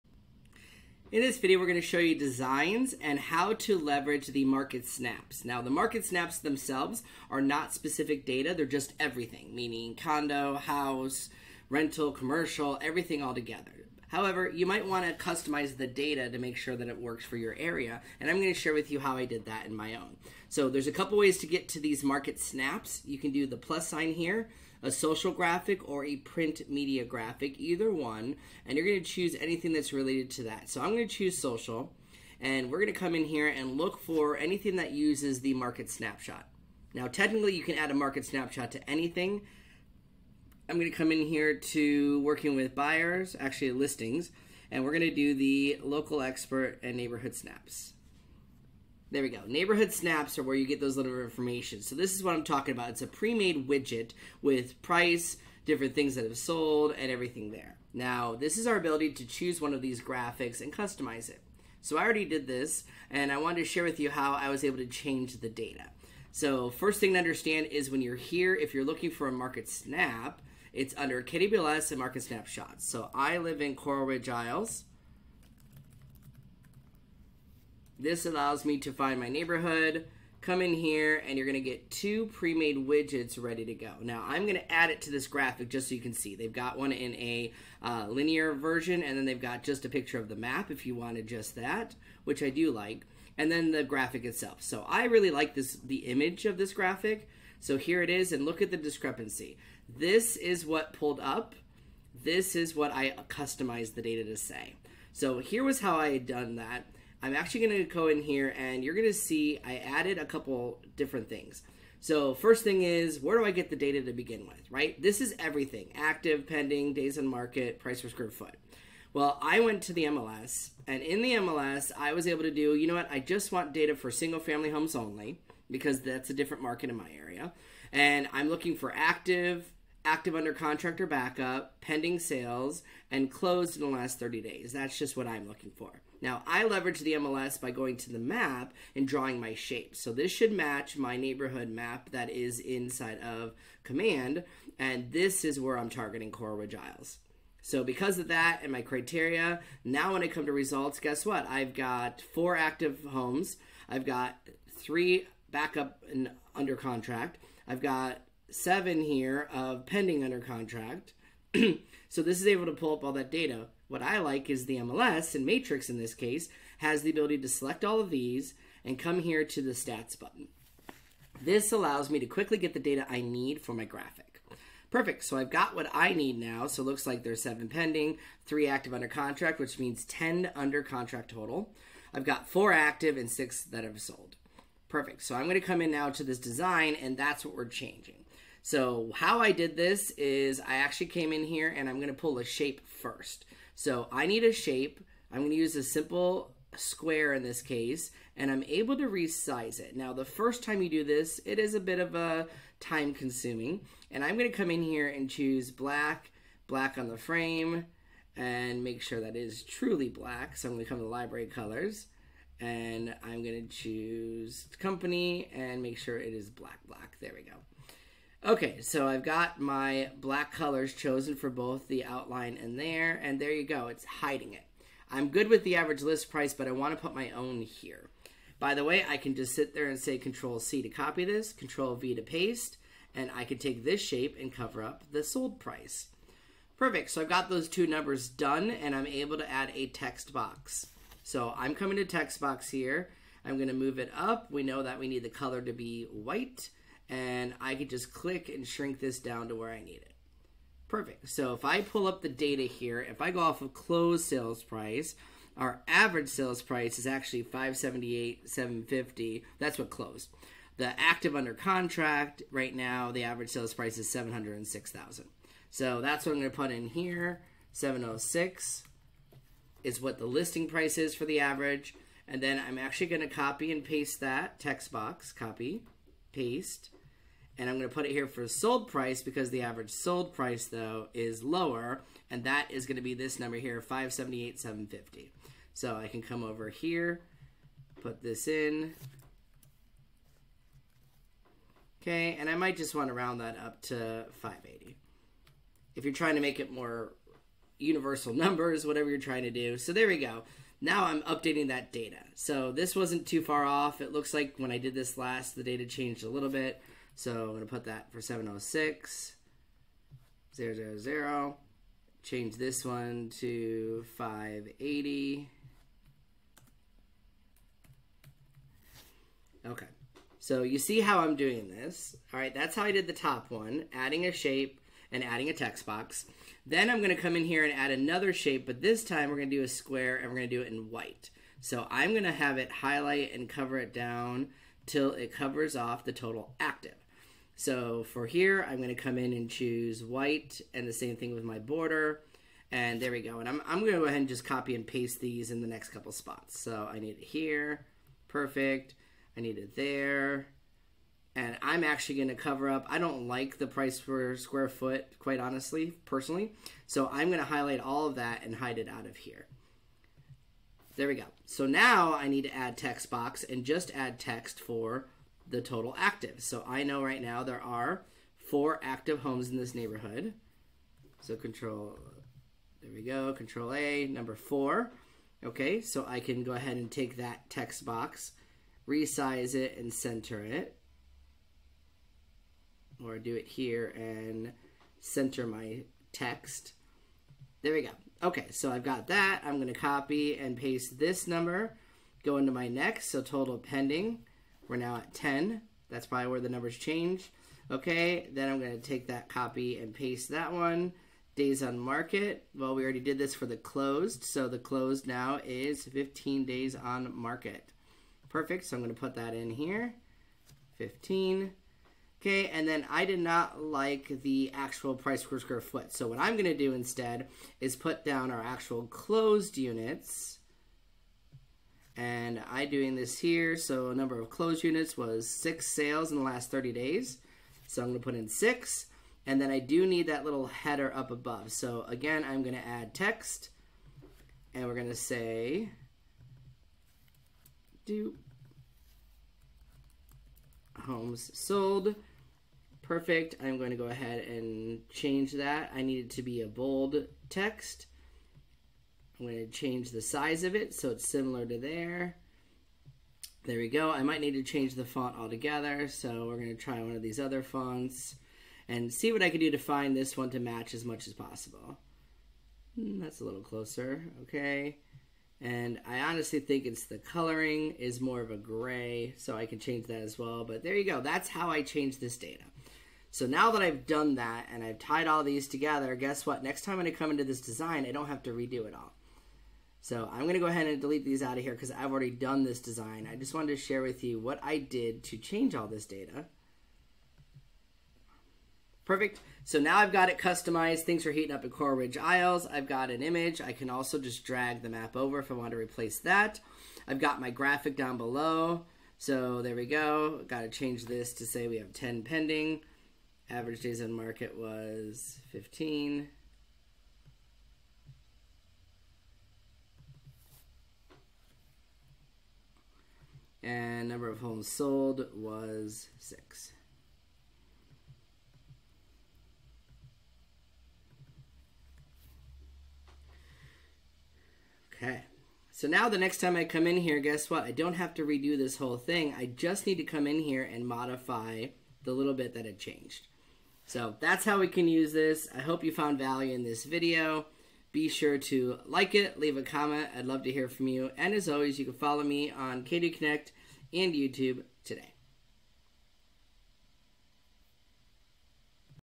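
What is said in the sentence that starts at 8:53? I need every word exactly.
So that's how we can use this.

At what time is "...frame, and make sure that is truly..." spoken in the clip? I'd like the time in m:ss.
3:27.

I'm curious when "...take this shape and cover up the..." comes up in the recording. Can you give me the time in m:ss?
3:53.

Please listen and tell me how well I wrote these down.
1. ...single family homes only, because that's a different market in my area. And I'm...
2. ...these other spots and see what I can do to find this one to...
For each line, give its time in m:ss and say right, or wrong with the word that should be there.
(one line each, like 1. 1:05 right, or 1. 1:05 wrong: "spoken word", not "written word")
1. 2:04 right
2. 7:37 wrong: "fonts", not "spots".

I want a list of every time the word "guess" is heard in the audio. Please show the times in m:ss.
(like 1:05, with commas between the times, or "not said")
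2:30, 7:55, 8:46.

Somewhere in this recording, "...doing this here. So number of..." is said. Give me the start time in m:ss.
7:02.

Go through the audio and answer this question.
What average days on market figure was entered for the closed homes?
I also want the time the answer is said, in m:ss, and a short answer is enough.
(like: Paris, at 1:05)
15, at 6:45.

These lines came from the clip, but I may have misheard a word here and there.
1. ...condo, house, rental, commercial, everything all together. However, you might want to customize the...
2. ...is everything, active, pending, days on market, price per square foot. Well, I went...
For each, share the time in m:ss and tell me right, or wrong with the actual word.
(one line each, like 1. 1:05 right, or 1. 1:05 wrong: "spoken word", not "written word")
1. 0:09 right
2. 1:55 right.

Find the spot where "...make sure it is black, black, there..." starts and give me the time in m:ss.
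3:35.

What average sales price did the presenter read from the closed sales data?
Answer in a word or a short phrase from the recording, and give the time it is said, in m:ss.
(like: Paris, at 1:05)
578,750, at 4:17.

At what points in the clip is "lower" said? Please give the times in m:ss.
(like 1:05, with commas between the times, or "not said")
4:41.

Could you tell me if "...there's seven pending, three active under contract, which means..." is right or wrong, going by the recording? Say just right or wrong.
right.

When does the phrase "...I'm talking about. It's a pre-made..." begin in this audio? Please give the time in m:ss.
0:52.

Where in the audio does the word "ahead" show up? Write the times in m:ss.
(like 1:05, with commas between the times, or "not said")
5:44, 6:16, 7:23, 8:00.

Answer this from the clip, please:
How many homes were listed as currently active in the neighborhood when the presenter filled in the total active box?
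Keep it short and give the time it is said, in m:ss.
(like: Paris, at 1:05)
4, at 6:14.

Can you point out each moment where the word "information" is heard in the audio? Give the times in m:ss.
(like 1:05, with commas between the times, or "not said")
0:51.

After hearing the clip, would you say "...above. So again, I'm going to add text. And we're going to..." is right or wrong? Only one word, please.
right.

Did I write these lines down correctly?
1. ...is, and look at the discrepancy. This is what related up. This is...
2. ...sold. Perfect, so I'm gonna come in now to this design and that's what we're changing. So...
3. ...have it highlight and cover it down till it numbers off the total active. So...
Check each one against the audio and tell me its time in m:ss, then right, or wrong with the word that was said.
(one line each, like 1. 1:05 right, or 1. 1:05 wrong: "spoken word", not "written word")
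1. 1:38 wrong: "pulled", not "related"
2. 3:03 right
3. 5:32 wrong: "covers", not "numbers".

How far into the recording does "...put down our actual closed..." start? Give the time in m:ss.
6:57.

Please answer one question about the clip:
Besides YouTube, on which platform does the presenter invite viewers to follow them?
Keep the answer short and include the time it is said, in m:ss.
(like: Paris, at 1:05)
KW Connect, at 9:02.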